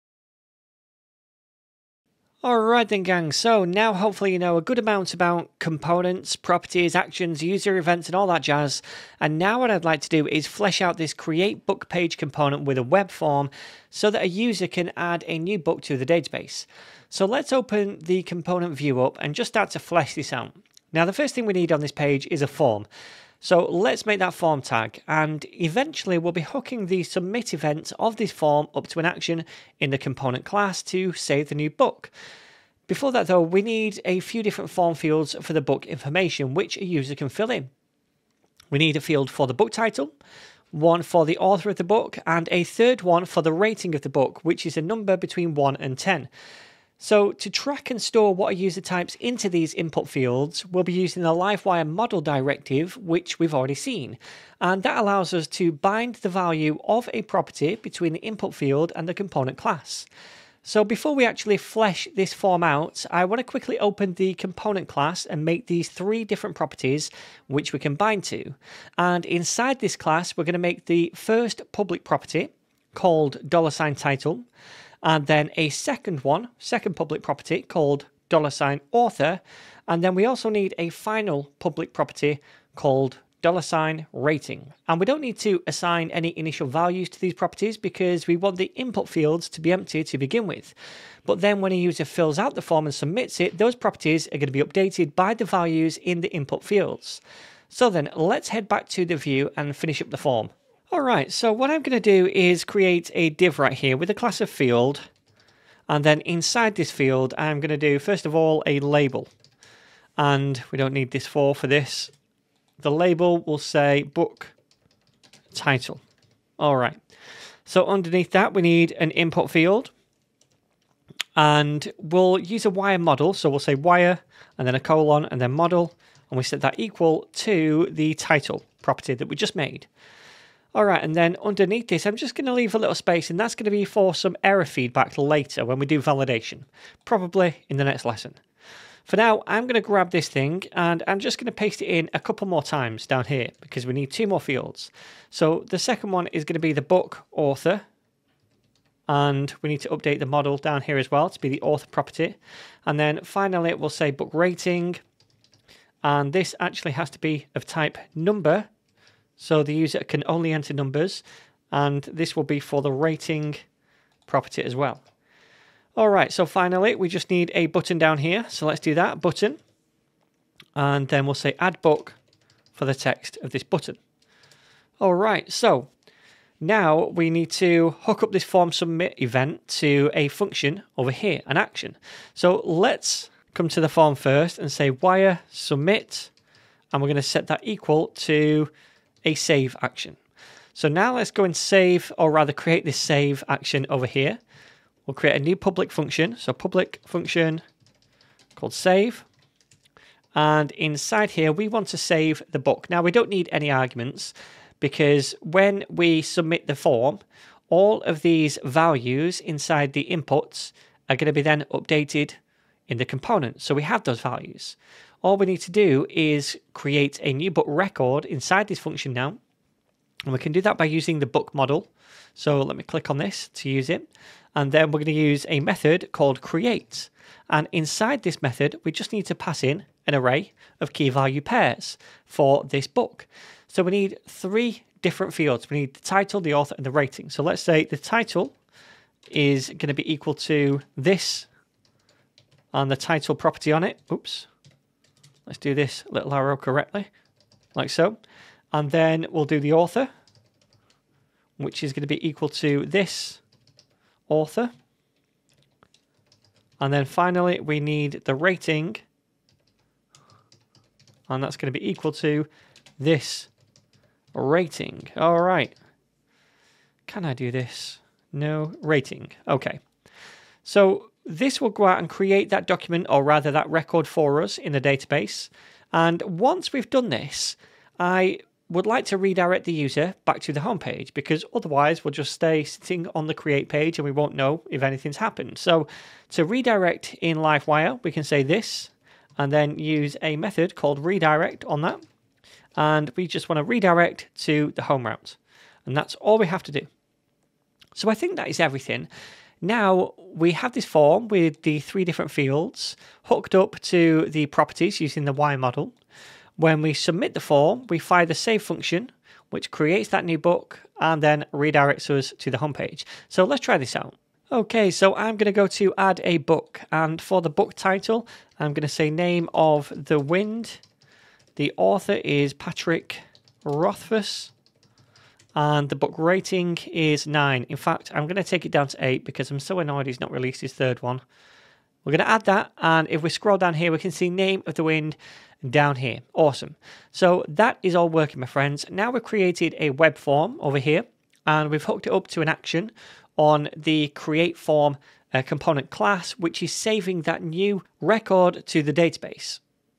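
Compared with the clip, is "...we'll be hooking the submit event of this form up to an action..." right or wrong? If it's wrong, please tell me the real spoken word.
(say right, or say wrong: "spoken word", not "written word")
right.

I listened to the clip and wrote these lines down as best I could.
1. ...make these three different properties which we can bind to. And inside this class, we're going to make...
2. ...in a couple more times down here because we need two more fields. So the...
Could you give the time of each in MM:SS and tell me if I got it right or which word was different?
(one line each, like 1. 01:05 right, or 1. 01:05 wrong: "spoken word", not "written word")
1. 01:05 right
2. 02:21 right.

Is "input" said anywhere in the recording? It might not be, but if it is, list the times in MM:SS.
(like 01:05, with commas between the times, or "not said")
00:49, 00:58, 01:28, 01:36, 01:59, 03:30.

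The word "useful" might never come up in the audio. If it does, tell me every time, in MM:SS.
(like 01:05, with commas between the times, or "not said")
not said.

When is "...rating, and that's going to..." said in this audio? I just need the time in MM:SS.
04:18.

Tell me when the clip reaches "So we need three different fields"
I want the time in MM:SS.
03:53.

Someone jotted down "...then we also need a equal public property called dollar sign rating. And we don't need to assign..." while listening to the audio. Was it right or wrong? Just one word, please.
wrong.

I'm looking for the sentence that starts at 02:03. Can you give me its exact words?
So we'll say wire and then a colon and then model.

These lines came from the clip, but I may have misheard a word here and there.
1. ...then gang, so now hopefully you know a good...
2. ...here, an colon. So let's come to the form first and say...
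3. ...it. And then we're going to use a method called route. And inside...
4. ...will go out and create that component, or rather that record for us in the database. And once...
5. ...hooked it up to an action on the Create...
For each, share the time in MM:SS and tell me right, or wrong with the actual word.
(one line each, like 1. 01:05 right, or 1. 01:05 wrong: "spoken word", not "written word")
1. 00:02 right
2. 03:01 wrong: "action", not "colon"
3. 03:43 wrong: "create", not "route"
4. 04:31 wrong: "document", not "component"
5. 05:41 right.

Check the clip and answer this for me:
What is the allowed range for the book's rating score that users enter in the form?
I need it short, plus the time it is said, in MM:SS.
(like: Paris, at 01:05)
1 to 10, at 00:45.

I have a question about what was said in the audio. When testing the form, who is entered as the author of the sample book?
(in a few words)
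Patrick Rothfuss.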